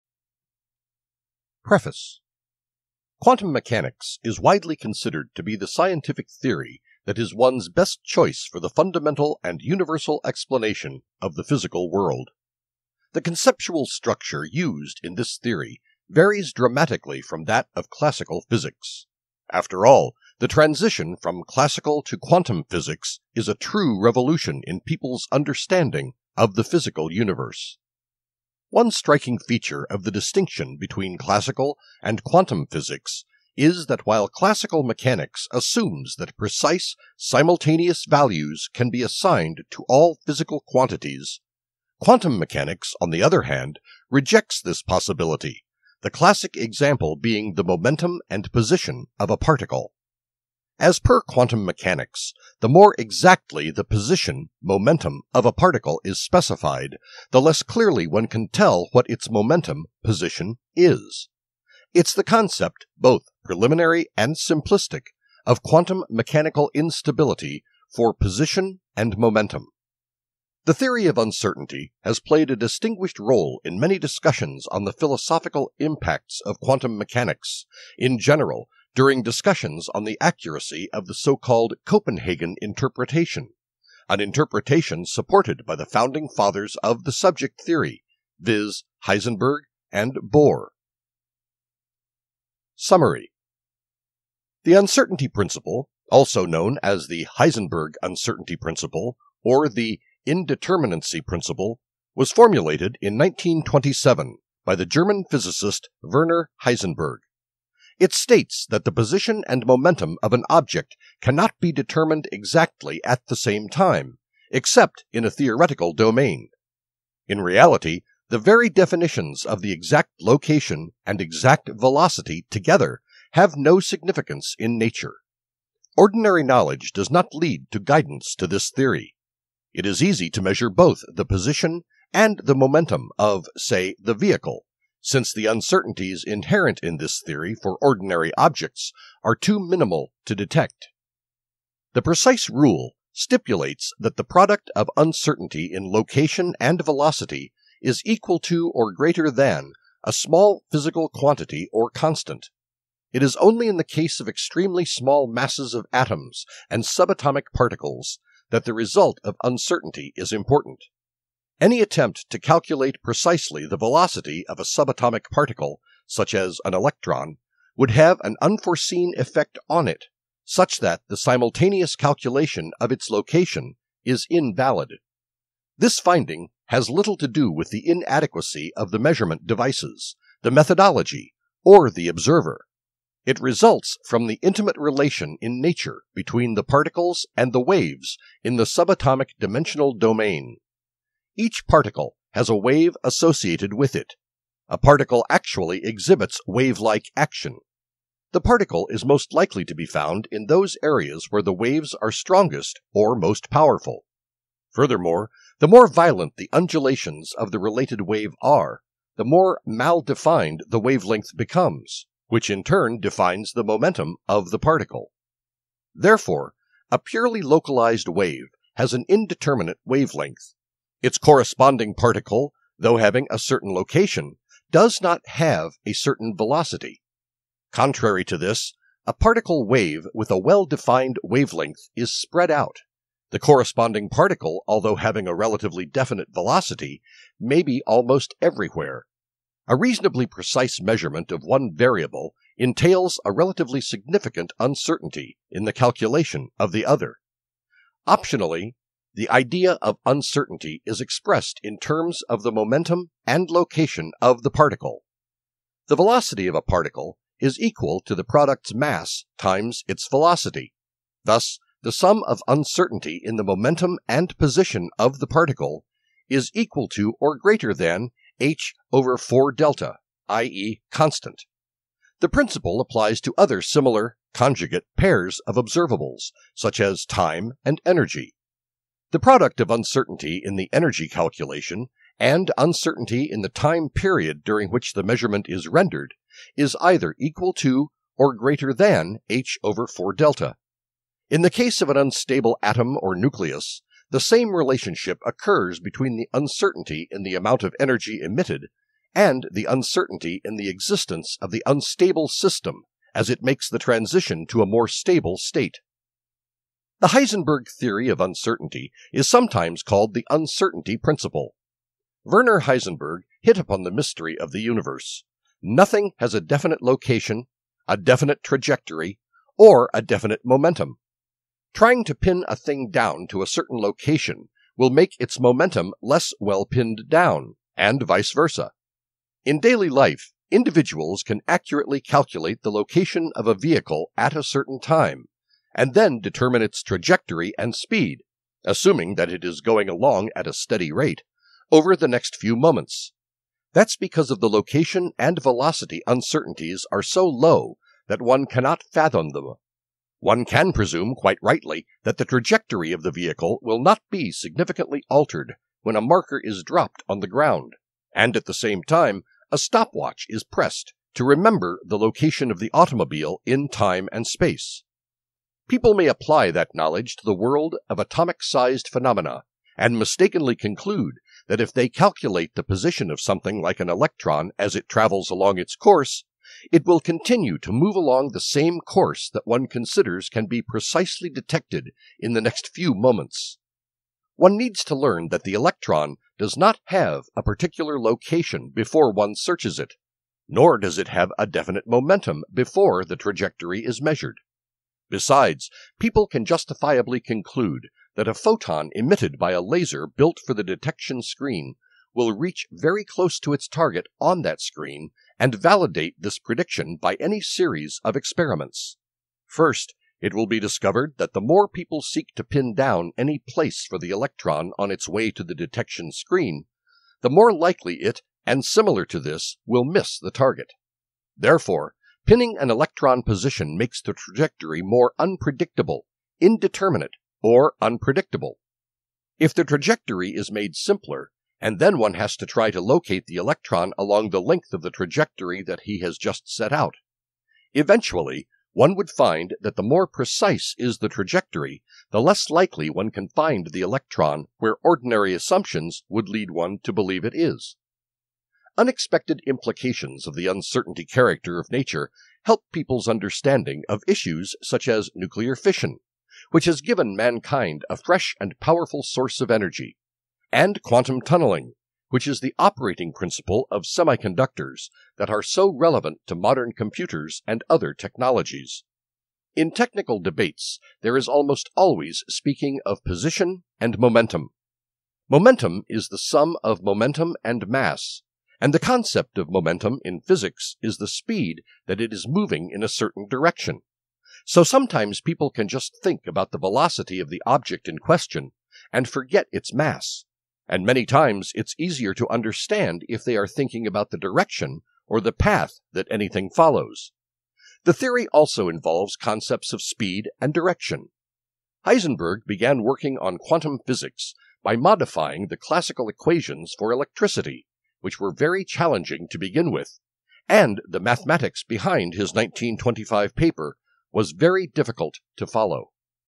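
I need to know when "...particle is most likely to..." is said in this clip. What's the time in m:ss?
3:18.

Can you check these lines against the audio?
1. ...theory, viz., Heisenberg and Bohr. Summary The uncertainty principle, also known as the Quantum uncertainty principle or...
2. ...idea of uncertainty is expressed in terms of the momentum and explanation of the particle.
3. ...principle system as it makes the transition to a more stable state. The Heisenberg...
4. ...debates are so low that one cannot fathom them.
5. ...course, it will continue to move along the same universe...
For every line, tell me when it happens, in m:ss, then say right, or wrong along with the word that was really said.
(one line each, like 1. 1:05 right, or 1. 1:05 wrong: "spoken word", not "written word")
1. 1:27 wrong: "Heisenberg", not "Quantum"
2. 4:09 wrong: "location", not "explanation"
3. 5:01 wrong: "unstable", not "principle"
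4. 5:46 wrong: "uncertainties", not "debates"
5. 6:15 wrong: "course", not "universe".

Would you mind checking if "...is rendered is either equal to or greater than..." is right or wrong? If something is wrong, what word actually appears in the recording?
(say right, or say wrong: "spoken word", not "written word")
right.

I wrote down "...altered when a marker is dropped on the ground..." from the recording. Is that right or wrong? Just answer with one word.
right.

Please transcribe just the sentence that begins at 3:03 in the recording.
It results from the intimate relation in nature between the particles and the waves in the subatomic dimensional domain.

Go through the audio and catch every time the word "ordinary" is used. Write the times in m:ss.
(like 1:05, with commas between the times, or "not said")
2:05, 2:17, 7:24.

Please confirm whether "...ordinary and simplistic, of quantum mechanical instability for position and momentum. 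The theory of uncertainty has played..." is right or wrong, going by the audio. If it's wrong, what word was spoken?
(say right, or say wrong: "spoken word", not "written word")
wrong: "preliminary", not "ordinary".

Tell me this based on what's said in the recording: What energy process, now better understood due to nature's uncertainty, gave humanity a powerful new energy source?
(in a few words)
nuclear fission.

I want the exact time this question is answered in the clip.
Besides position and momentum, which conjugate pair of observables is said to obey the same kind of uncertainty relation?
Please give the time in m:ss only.
4:37.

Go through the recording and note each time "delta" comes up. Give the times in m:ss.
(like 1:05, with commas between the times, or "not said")
4:29, 4:50.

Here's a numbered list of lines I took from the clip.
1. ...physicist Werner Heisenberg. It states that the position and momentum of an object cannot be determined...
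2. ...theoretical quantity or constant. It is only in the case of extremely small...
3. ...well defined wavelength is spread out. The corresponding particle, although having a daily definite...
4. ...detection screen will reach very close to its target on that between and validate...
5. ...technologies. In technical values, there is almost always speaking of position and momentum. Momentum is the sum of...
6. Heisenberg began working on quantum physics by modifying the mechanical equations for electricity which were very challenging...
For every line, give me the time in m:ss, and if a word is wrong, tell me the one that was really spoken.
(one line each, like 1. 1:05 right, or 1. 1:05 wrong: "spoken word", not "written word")
1. 1:45 right
2. 2:30 wrong: "physical", not "theoretical"
3. 3:50 wrong: "relatively", not "daily"
4. 6:40 wrong: "screen", not "between"
5. 7:47 wrong: "debates", not "values"
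6. 8:21 wrong: "classical", not "mechanical".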